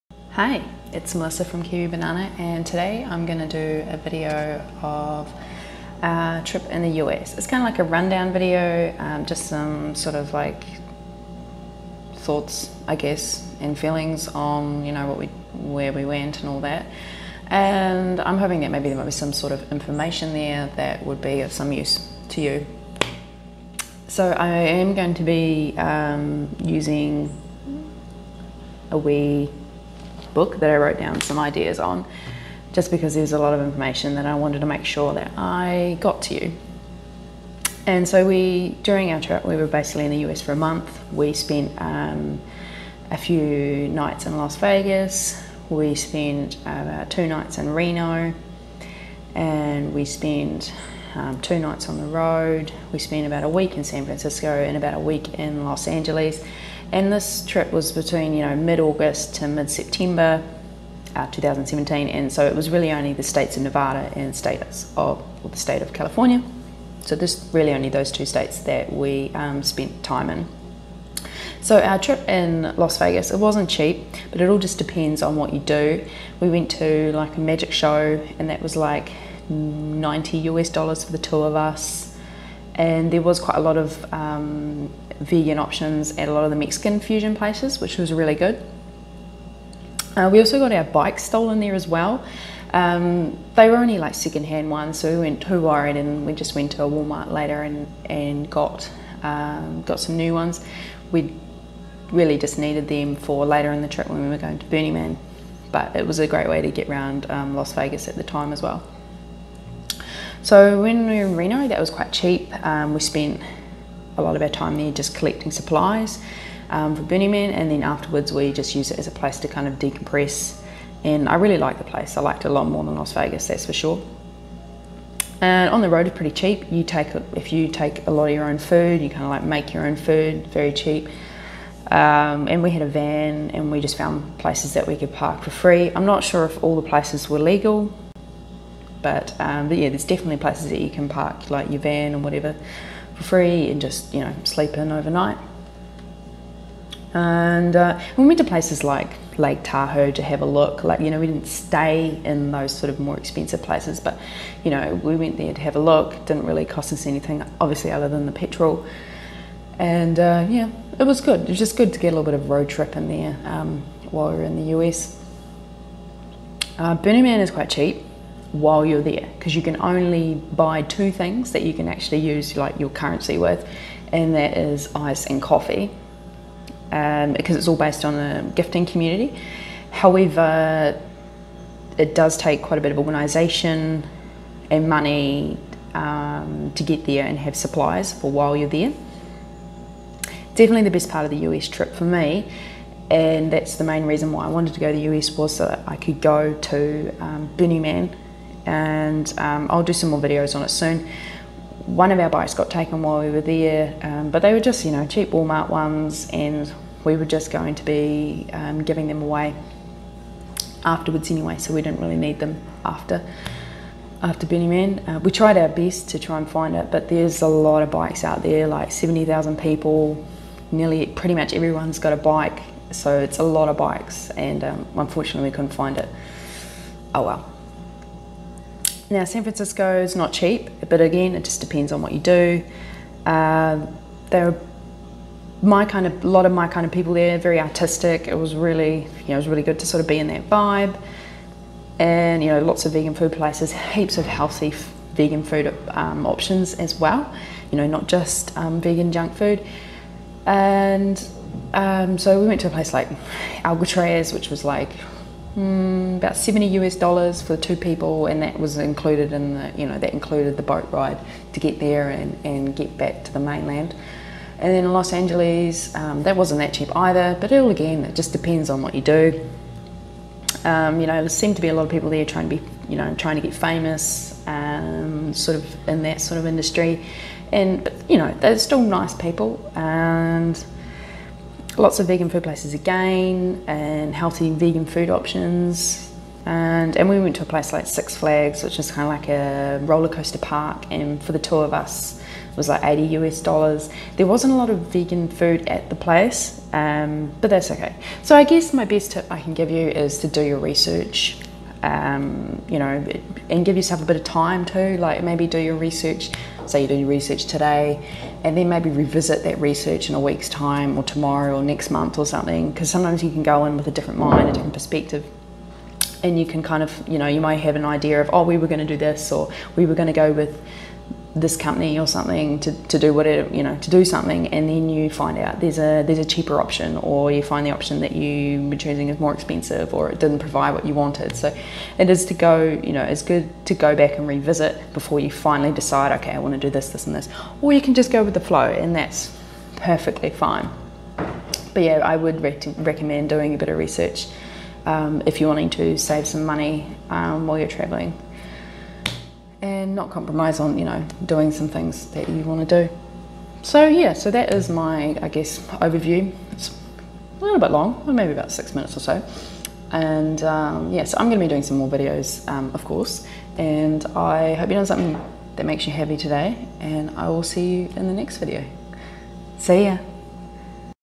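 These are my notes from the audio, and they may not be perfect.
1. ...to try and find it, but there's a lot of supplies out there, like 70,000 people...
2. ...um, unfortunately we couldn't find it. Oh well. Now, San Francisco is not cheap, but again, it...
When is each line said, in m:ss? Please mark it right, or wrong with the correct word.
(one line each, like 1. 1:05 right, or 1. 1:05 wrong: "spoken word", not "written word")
1. 3:36 wrong: "bikes", not "supplies"
2. 3:44 right.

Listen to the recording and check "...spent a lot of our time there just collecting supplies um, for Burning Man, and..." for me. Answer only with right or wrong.
right.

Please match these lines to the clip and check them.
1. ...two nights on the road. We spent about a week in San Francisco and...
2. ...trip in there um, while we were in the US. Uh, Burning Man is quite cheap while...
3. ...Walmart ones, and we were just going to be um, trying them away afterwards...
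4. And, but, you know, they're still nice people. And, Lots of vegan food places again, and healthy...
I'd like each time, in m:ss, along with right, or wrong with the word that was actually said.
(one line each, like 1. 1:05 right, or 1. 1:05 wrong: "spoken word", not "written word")
1. 0:51 right
2. 2:42 right
3. 3:25 wrong: "giving", not "trying"
4. 4:37 right.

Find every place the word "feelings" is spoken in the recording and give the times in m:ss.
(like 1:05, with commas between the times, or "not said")
0:13.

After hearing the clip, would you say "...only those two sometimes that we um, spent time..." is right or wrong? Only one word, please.
wrong.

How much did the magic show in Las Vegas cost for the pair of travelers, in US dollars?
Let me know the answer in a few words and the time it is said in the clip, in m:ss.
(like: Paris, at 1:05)
90, at 1:19.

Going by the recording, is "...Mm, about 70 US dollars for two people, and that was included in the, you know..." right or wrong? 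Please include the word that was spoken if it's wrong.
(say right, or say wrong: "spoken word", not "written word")
right.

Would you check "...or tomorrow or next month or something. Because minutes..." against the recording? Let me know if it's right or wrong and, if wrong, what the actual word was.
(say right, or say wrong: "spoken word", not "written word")
wrong: "sometimes", not "minutes".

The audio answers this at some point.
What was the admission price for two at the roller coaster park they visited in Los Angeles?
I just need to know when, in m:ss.
4:52.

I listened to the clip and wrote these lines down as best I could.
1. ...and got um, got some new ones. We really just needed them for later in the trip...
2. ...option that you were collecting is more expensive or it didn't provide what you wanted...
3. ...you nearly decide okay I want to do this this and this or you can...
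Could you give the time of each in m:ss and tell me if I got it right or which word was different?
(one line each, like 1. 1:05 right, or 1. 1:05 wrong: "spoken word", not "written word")
1. 1:38 right
2. 5:27 wrong: "choosing", not "collecting"
3. 5:35 wrong: "finally", not "nearly".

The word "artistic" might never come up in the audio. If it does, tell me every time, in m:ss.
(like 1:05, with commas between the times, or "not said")
3:57.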